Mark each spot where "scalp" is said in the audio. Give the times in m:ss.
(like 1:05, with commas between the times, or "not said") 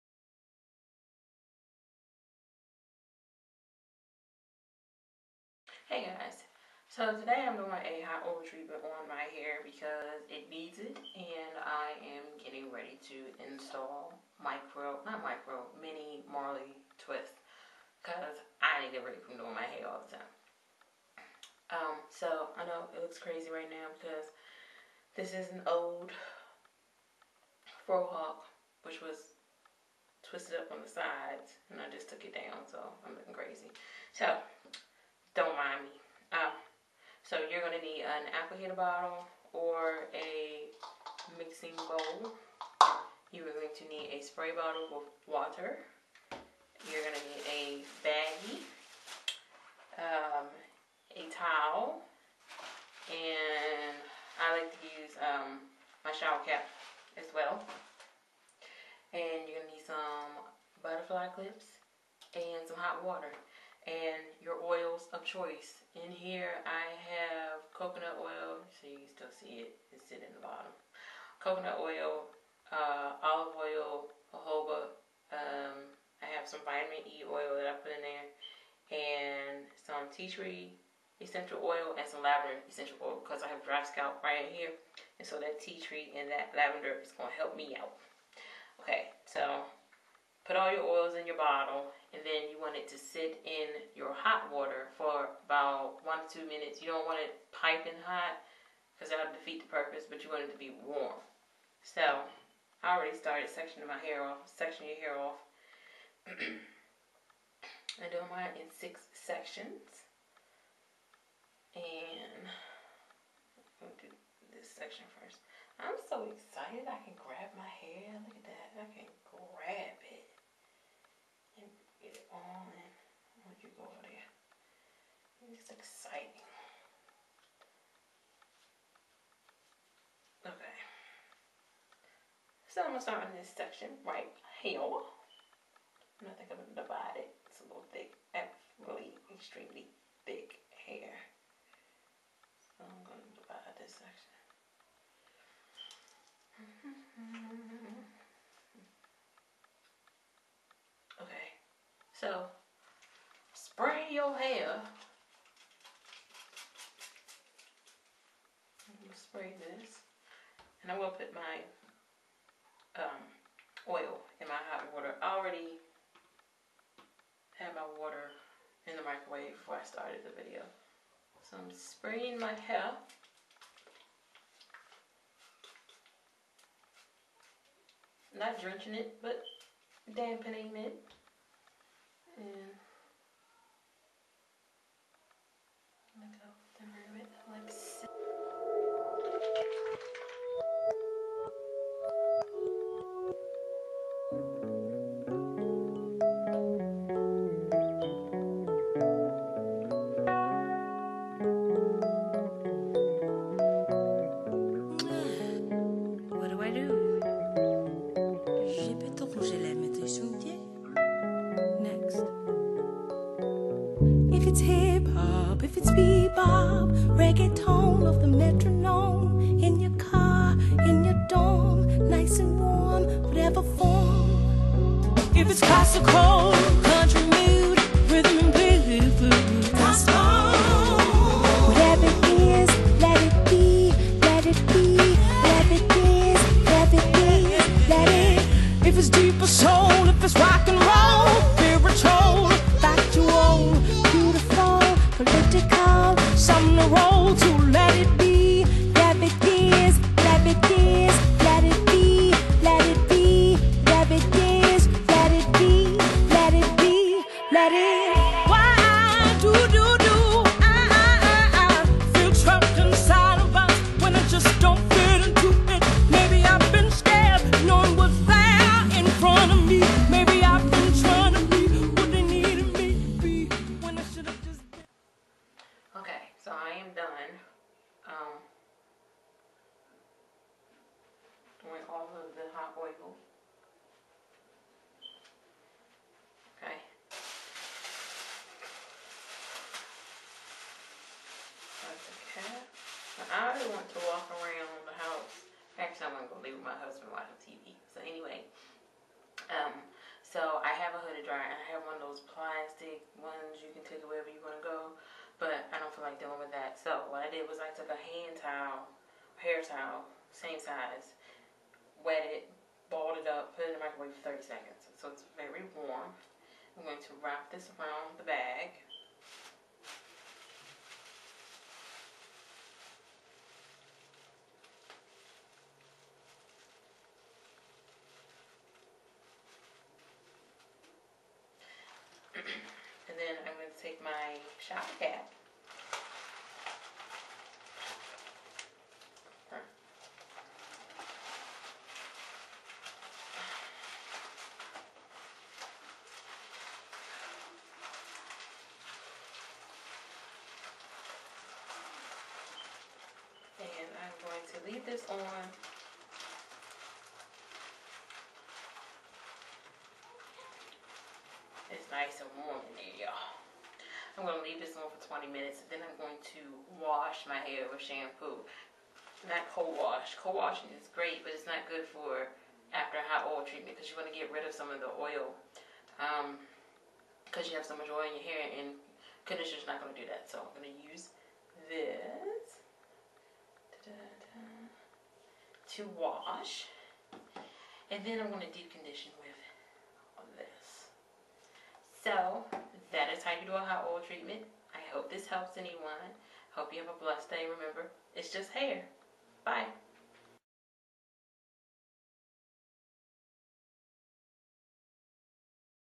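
1:23.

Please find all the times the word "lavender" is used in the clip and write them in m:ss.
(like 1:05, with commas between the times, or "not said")
1:22, 1:26.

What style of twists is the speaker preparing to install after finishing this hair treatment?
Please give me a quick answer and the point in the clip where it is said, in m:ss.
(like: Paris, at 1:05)
mini Marley twist, at 0:15.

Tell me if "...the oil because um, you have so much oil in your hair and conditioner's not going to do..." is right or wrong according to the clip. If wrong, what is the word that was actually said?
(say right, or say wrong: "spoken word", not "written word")
right.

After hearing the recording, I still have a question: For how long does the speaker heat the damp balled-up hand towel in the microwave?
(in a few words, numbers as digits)
30 seconds.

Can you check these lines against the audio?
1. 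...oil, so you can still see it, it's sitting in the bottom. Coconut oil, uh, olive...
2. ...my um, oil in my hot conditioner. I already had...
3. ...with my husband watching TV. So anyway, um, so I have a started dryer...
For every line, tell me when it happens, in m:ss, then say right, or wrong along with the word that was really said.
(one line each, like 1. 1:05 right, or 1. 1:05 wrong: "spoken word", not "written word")
1. 1:08 right
2. 2:41 wrong: "water", not "conditioner"
3. 4:56 wrong: "hooded", not "started".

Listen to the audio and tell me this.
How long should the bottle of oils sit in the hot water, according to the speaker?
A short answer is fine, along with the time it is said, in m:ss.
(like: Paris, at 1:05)
1 to 2 minutes, at 1:36.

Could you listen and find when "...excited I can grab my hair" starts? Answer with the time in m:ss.
1:56.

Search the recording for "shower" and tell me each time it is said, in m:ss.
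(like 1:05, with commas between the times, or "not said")
0:56, 5:34.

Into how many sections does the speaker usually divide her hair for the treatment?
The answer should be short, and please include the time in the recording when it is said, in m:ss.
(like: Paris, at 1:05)
6, at 1:48.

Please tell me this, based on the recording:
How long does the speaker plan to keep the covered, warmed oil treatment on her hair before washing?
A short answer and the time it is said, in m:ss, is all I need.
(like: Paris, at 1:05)
20 minutes, at 6:05.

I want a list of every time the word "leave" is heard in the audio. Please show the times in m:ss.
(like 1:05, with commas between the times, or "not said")
4:56, 5:54, 6:04.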